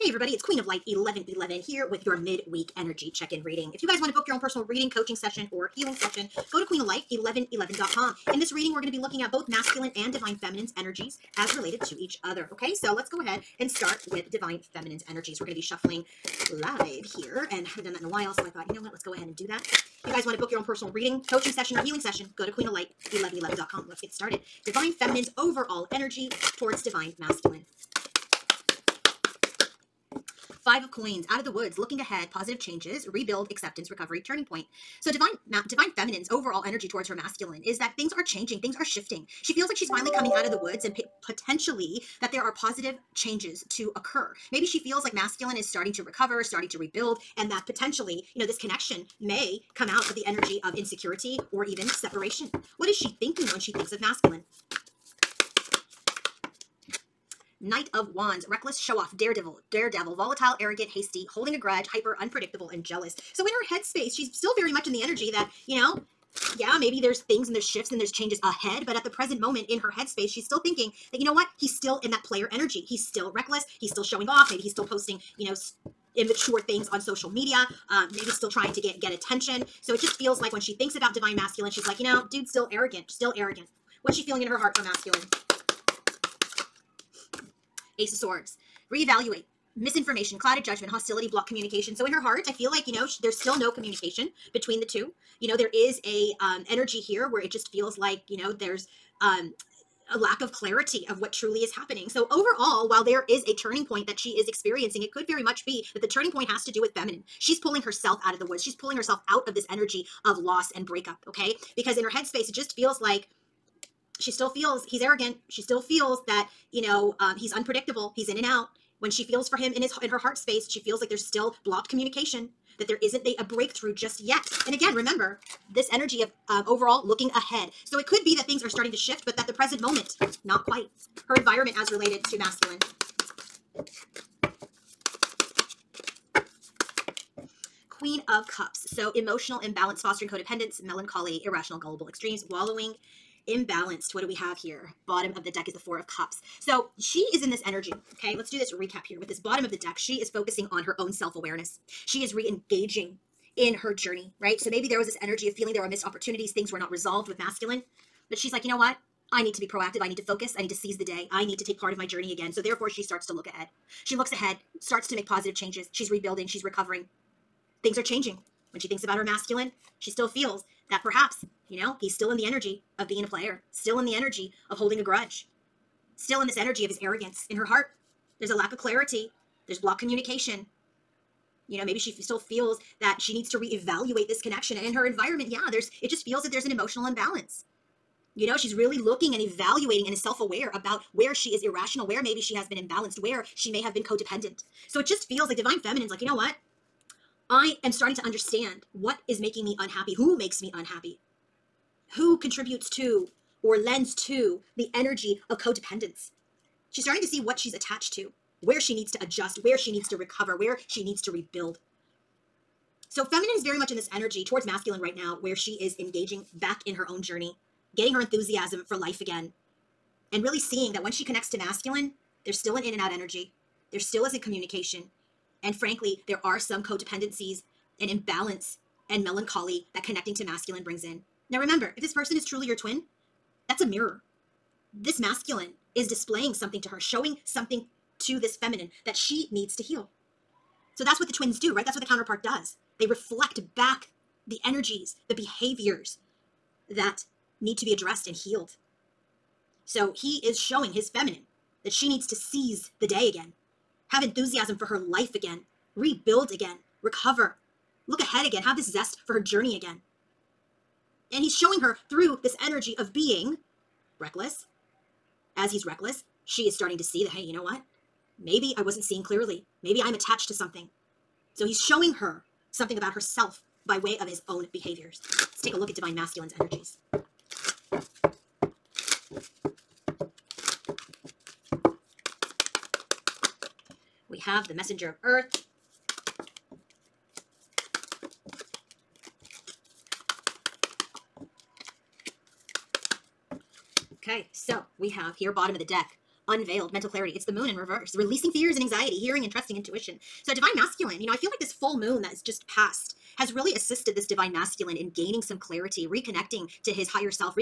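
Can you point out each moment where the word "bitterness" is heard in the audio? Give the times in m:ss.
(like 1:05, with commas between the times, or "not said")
not said.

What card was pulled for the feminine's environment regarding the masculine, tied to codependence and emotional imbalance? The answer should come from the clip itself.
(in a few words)
Queen of Cups.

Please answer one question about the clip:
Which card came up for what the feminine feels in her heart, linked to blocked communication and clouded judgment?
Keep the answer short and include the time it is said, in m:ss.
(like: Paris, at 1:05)
Ace of Swords, at 1:27.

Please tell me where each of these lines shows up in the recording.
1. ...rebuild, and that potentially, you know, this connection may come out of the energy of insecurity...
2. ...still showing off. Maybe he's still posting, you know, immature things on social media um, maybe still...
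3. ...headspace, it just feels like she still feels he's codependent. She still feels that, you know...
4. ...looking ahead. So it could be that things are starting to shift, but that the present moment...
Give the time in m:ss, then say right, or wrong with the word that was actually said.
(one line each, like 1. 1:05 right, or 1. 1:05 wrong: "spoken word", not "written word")
1. 0:46 right
2. 1:13 right
3. 1:52 wrong: "arrogant", not "codependent"
4. 2:07 right.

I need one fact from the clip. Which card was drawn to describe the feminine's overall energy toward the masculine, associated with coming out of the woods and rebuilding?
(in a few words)
Five of Coins.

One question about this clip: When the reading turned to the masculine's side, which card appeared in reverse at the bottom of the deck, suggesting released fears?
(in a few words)
The Moon.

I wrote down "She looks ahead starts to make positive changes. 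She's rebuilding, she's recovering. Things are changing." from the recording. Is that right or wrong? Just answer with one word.
right.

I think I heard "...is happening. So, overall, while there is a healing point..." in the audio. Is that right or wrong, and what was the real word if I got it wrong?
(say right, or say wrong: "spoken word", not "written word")
wrong: "turning", not "healing".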